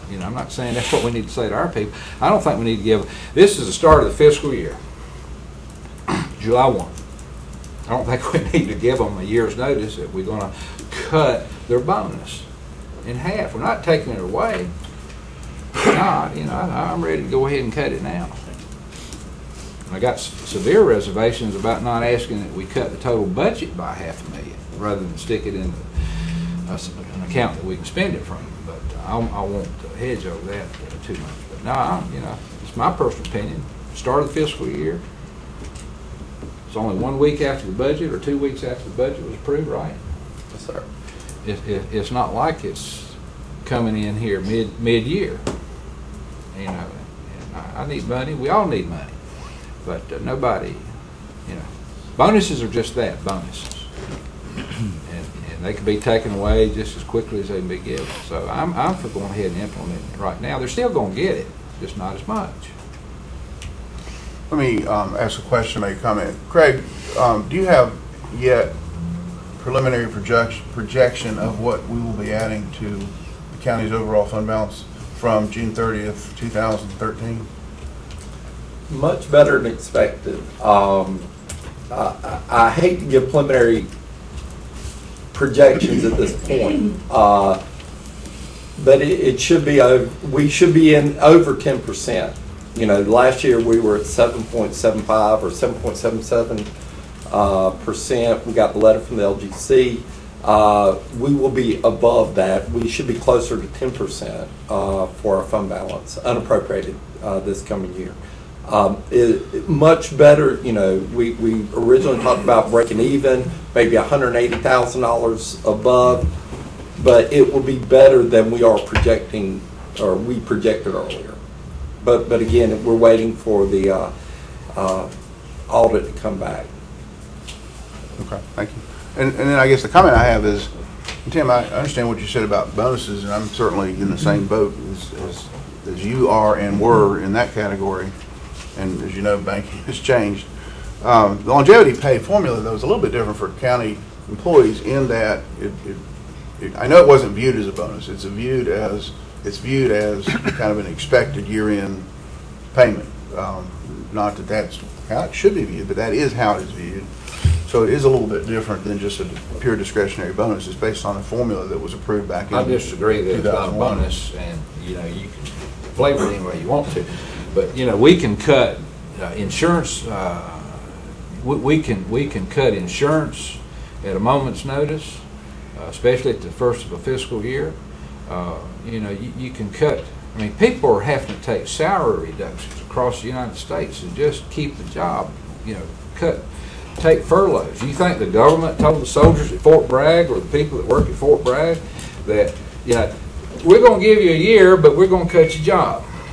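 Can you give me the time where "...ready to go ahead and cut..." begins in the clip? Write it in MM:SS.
00:17.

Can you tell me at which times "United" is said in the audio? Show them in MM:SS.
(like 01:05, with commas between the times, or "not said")
03:03.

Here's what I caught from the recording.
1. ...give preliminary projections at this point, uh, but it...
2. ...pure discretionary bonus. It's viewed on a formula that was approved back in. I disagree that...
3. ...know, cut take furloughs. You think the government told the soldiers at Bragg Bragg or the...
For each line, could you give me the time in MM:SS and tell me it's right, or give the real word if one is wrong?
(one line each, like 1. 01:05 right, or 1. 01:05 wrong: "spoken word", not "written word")
1. 01:23 right
2. 02:39 wrong: "based", not "viewed"
3. 03:05 wrong: "Fort", not "Bragg".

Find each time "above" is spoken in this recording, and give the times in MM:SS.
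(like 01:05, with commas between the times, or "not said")
01:41, 01:55.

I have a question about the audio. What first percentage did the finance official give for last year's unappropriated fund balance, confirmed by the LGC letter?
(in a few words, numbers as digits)
7.75.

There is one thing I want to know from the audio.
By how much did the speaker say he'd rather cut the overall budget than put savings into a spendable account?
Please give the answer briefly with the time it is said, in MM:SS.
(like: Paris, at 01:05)
half a million, at 00:23.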